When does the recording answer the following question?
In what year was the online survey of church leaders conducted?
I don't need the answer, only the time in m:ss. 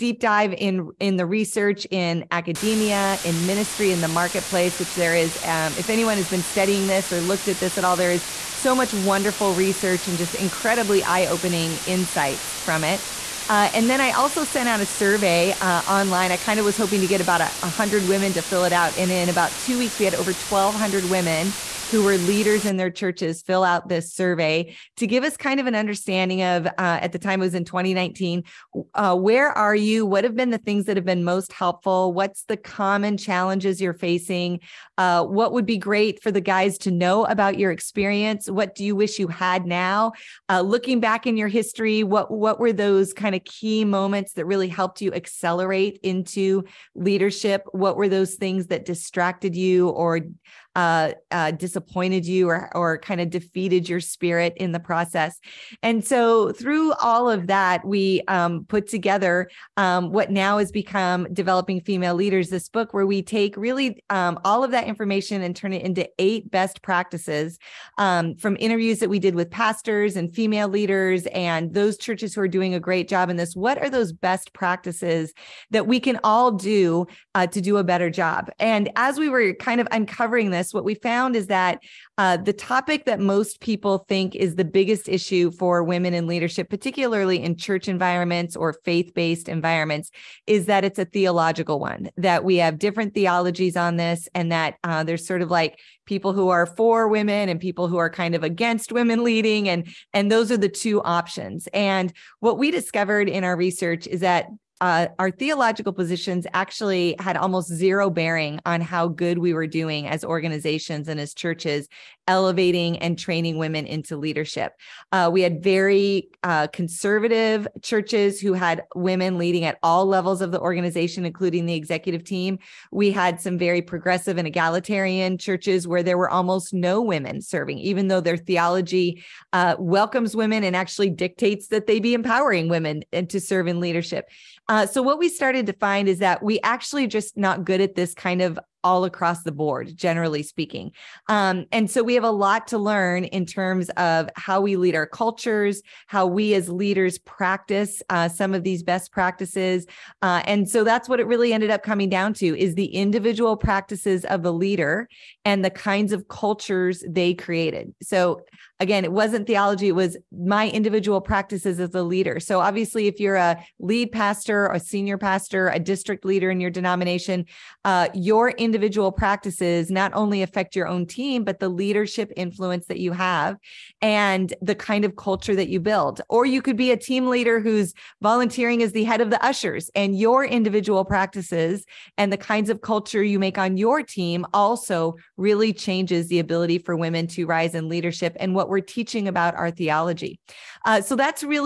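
0:27.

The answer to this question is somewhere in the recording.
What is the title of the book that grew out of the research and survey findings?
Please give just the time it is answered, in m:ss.
1:01.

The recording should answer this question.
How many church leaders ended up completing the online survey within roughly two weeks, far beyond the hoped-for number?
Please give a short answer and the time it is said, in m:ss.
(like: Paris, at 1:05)
1,200, at 0:20.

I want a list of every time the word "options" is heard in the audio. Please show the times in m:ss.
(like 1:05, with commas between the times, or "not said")
1:41.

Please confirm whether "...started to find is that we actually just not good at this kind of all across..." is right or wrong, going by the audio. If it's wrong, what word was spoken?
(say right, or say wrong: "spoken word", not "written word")
right.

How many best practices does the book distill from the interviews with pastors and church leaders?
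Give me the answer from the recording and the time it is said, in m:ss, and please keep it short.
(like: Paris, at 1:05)
8, at 1:06.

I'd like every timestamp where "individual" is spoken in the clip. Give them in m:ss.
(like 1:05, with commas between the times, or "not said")
2:32, 2:40, 2:48, 3:00.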